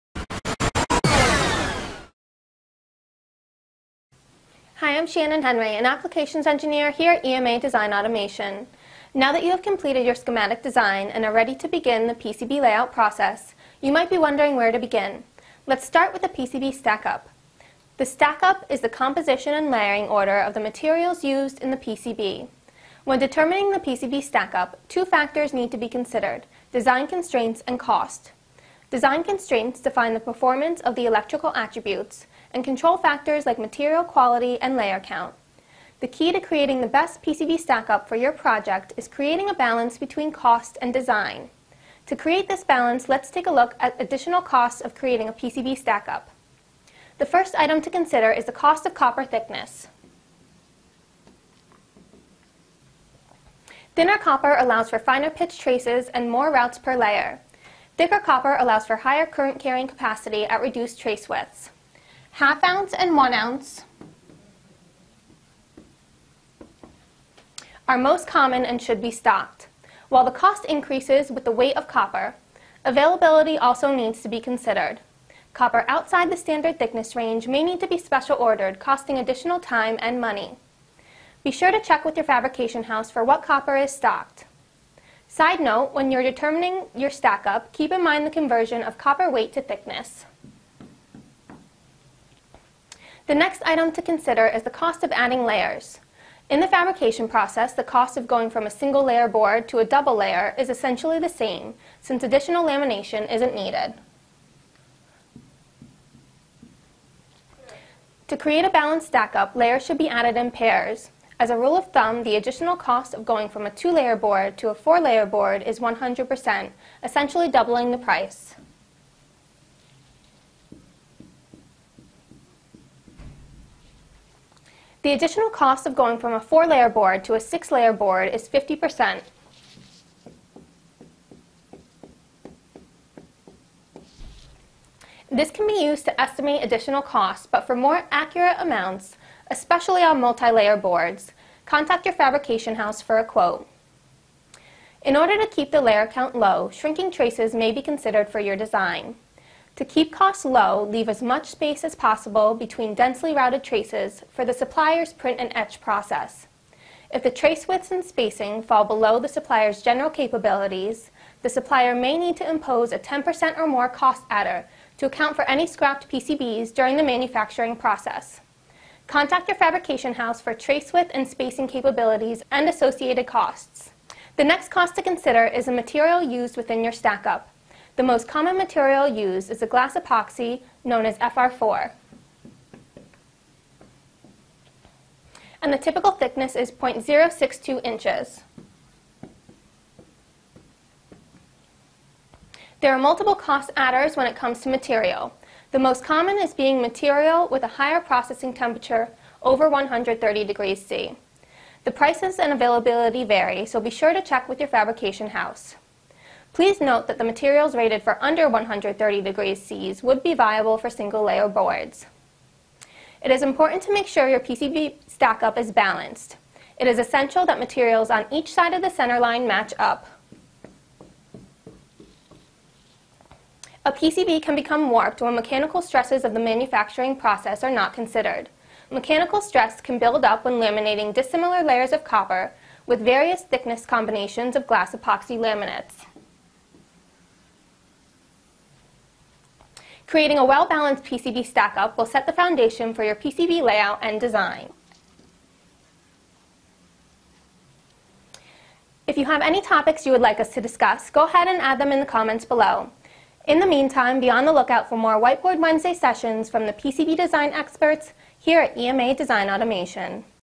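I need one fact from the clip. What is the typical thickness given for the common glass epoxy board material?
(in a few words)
0.062 inches.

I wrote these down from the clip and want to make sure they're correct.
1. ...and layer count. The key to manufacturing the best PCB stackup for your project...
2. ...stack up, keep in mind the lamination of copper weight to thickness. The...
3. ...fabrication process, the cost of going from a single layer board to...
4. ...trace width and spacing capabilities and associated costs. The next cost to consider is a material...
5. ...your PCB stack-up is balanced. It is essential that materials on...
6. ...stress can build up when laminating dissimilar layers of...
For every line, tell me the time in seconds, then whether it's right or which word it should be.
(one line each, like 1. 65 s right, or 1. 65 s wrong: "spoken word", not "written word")
1. 34 s wrong: "creating", not "manufacturing"
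2. 87 s wrong: "conversion", not "lamination"
3. 96 s right
4. 170 s right
5. 214 s right
6. 229 s right.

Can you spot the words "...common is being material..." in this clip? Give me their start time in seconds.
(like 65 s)
196 s.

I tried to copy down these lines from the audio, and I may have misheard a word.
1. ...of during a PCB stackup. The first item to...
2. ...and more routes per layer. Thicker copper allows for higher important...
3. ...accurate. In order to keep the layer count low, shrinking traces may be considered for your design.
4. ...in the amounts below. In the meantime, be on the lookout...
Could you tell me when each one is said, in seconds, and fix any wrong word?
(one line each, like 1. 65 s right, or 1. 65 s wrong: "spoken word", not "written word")
1. 44 s wrong: "creating", not "during"
2. 56 s wrong: "current", not "important"
3. 143 s wrong: "quote", not "accurate"
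4. 251 s wrong: "comments", not "amounts".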